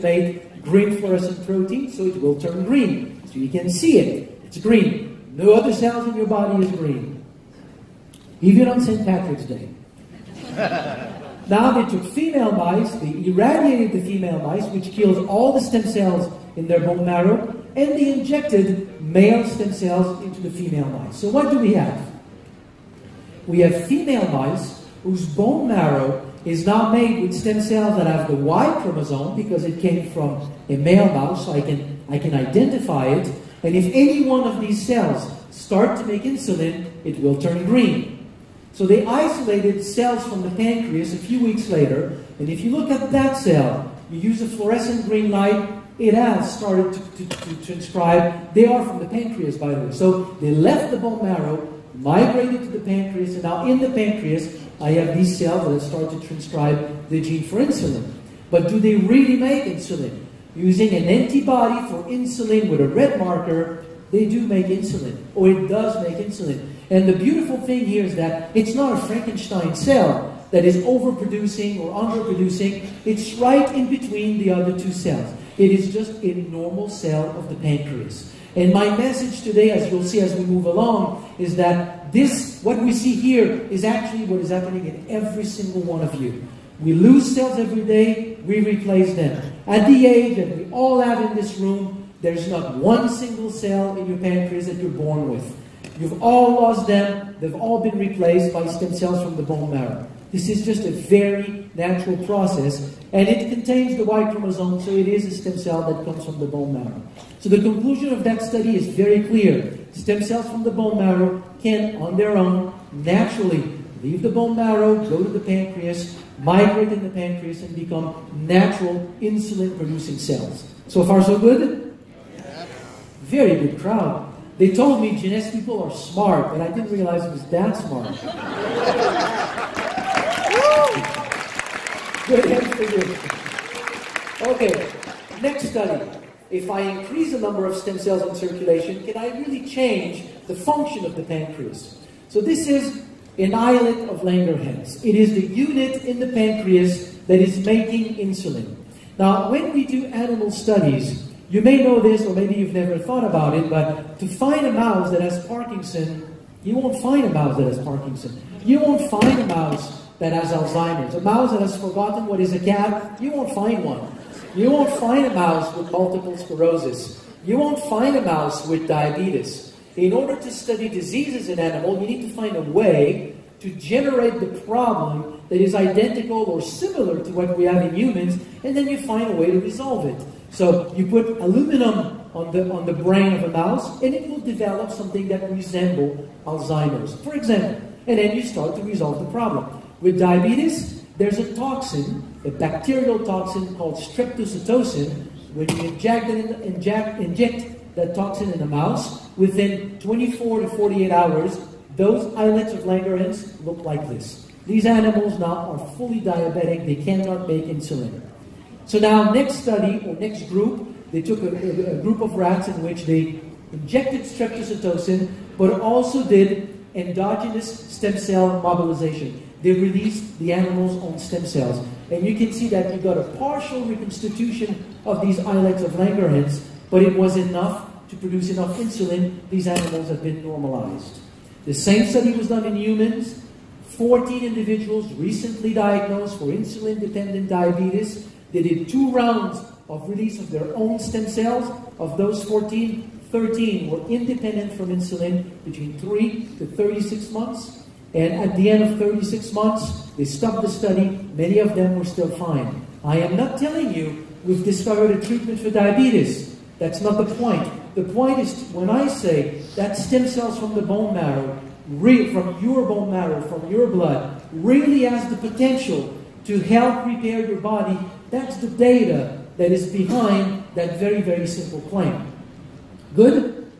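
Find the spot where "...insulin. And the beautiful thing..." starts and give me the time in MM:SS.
01:06.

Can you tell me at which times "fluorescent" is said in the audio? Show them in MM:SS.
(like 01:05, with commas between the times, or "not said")
00:00, 00:44.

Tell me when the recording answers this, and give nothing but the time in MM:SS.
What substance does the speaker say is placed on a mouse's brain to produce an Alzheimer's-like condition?
03:01.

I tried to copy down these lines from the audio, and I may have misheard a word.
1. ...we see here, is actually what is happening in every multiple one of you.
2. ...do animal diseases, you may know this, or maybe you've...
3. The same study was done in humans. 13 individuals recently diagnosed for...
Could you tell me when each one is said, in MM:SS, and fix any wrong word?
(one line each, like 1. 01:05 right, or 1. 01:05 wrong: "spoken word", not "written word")
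1. 01:22 wrong: "single", not "multiple"
2. 02:29 wrong: "studies", not "diseases"
3. 03:51 wrong: "14", not "13".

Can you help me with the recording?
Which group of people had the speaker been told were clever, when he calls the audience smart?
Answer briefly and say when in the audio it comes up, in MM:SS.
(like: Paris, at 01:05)
Jeunesse people, at 02:05.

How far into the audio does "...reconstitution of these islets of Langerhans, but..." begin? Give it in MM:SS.
03:43.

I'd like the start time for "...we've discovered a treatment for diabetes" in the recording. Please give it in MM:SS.
04:14.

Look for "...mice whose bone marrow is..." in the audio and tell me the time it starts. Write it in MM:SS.
00:24.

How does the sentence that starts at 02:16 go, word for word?
If I increase the number of stem cells in circulation, can I really change the function of the pancreas?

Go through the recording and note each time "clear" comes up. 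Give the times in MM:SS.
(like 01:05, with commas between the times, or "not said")
01:49.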